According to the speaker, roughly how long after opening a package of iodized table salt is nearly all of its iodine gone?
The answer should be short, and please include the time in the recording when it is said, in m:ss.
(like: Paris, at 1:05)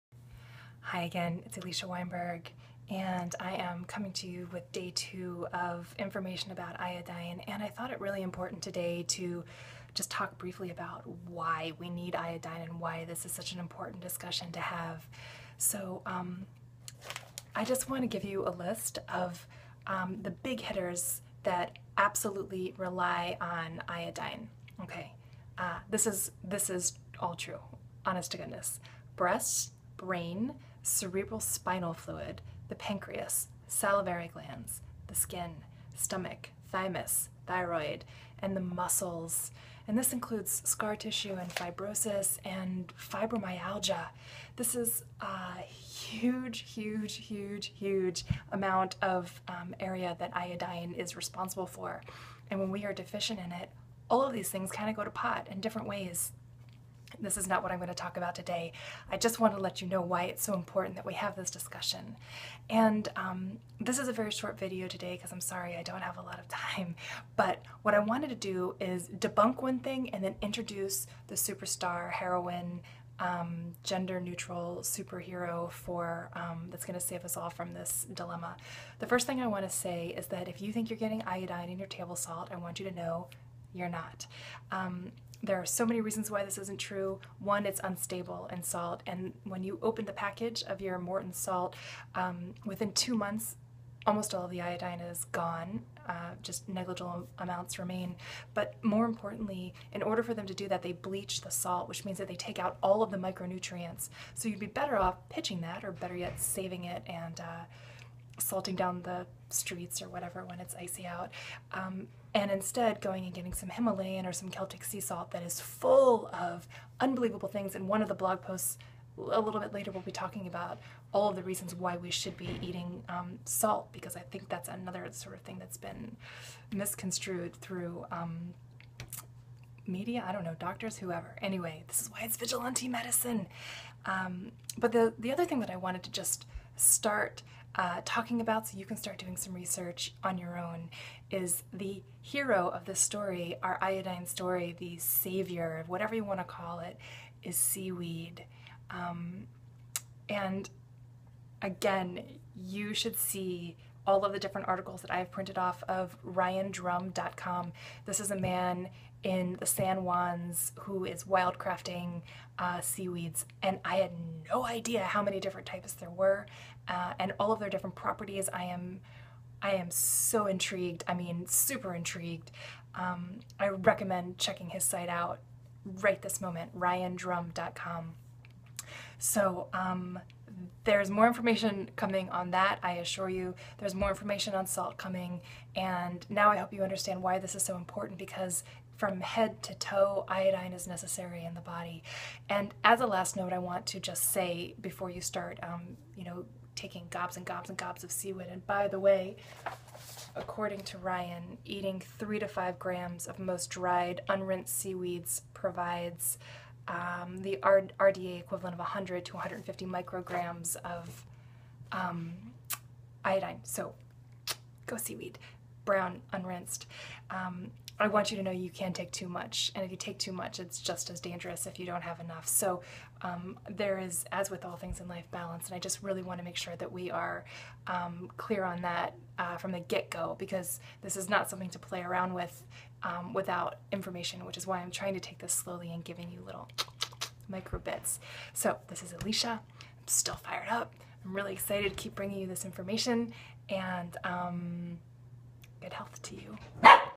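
2 months, at 1:32.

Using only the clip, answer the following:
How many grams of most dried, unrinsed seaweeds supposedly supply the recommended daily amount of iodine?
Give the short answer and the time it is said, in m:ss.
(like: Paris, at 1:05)
3 to 5 grams, at 3:22.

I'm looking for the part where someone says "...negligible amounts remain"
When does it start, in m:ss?
1:36.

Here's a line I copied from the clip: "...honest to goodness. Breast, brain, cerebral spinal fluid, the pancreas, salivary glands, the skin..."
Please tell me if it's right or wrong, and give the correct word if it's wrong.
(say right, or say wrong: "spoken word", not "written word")
right.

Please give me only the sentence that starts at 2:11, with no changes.
Anyway, this is why it's vigilante medicine.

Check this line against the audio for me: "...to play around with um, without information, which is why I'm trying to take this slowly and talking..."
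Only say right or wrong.
wrong.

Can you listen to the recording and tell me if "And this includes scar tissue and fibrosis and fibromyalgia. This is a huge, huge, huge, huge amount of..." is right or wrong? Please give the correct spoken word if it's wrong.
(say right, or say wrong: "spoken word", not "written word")
right.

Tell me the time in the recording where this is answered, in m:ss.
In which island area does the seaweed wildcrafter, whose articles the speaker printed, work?
2:39.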